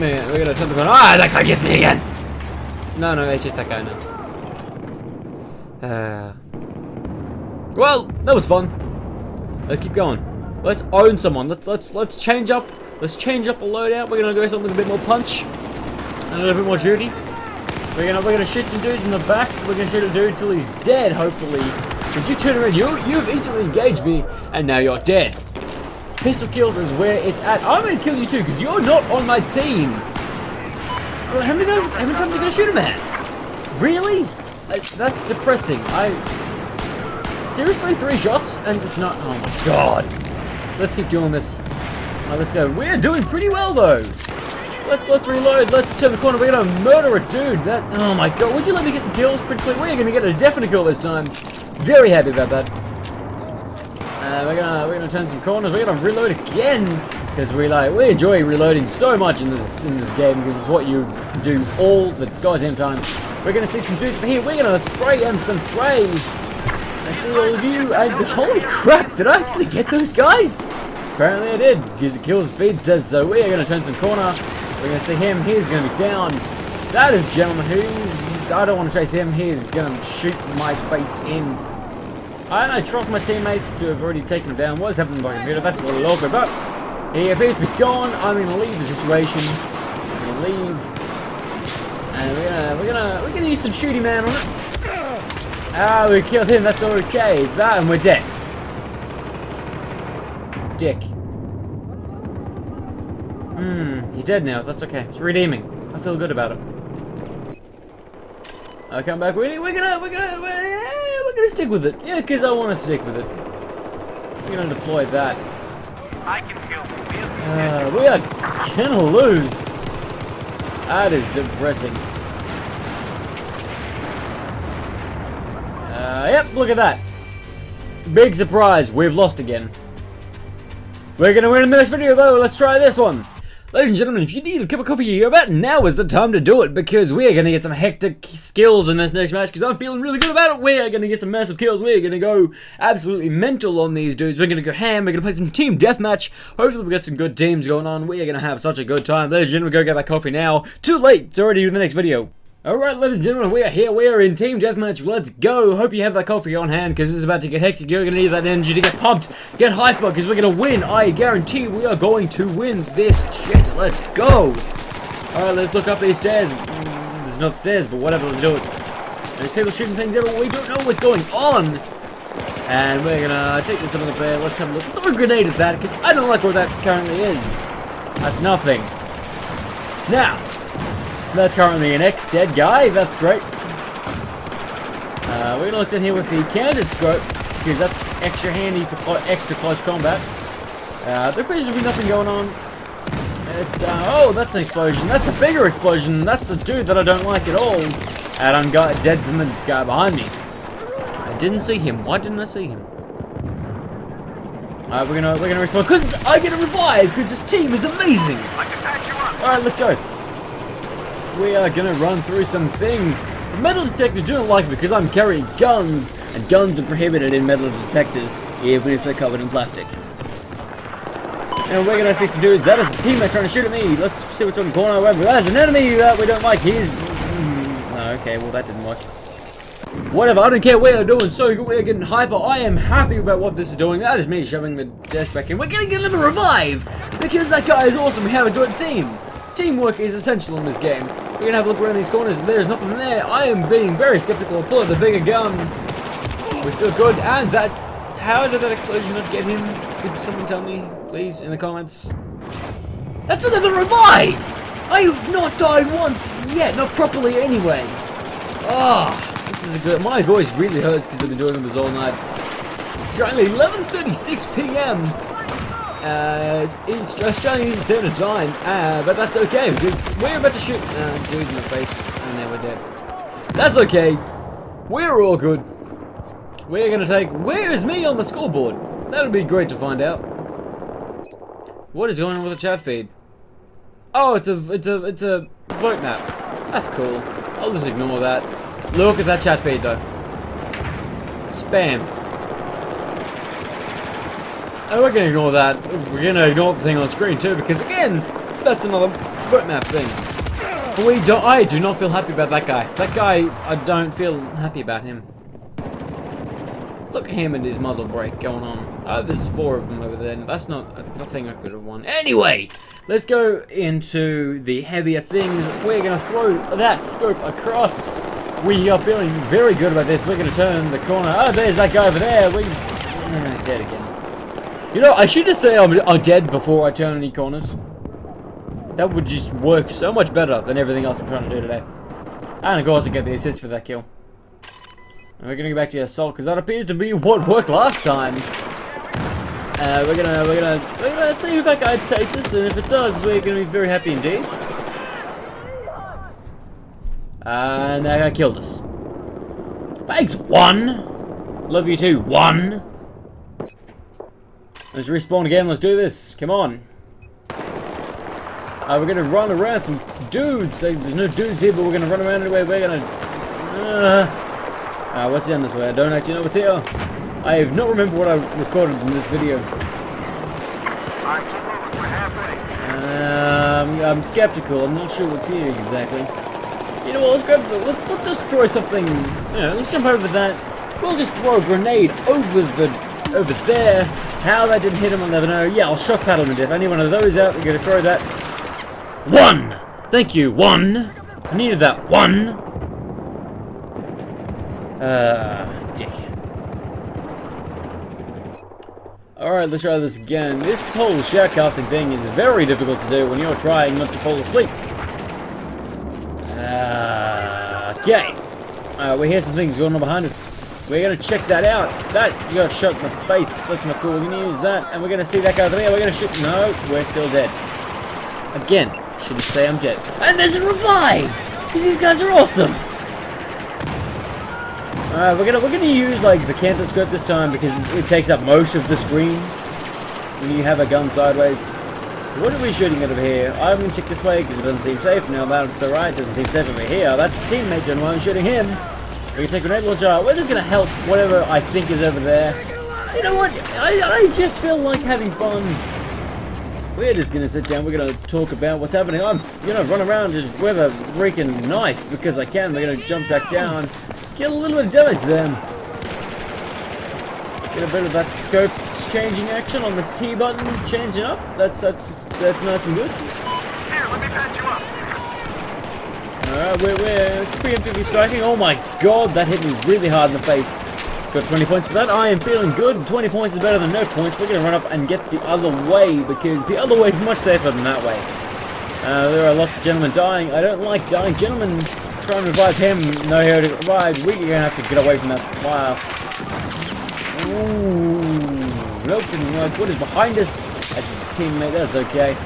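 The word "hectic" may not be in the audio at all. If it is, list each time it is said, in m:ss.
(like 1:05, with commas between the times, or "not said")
2:17, 2:37.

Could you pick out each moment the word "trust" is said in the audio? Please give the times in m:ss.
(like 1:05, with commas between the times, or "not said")
1:22.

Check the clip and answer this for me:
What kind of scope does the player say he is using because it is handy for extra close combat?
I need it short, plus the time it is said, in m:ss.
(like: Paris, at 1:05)
Canted scope, at 3:06.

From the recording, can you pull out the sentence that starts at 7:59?
Uh, there are lots of gentlemen dying.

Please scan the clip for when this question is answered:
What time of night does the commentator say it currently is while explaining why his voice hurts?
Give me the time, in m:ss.
4:23.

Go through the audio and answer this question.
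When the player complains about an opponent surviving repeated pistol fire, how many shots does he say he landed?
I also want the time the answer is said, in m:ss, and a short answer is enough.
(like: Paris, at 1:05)
3, at 0:37.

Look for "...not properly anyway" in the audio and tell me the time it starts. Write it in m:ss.
4:16.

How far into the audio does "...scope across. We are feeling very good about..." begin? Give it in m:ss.
5:17.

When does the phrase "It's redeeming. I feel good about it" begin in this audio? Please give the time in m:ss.
1:45.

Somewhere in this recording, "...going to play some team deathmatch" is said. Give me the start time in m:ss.
2:25.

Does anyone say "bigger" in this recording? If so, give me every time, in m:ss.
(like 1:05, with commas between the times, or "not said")
3:15, 4:04.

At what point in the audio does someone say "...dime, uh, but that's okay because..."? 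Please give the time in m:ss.
4:28.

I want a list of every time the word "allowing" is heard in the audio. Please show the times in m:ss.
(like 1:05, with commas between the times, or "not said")
not said.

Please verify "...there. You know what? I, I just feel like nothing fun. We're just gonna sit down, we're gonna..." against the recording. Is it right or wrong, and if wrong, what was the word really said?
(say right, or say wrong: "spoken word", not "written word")
wrong: "having", not "nothing".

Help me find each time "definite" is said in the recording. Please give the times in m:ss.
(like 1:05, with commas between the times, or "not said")
0:50.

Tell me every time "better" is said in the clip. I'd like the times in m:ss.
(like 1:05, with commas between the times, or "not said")
5:30, 7:53.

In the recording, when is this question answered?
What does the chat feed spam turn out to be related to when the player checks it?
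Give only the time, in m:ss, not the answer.
4:45.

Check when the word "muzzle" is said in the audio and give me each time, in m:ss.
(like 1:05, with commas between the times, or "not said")
5:07.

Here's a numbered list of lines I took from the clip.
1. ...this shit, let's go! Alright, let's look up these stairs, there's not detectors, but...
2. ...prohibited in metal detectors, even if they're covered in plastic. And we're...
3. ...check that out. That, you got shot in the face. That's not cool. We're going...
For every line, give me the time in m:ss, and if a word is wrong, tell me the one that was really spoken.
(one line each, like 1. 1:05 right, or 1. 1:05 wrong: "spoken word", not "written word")
1. 2:42 wrong: "stairs", not "detectors"
2. 3:36 right
3. 6:51 right.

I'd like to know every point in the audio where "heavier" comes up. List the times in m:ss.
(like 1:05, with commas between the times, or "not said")
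5:14.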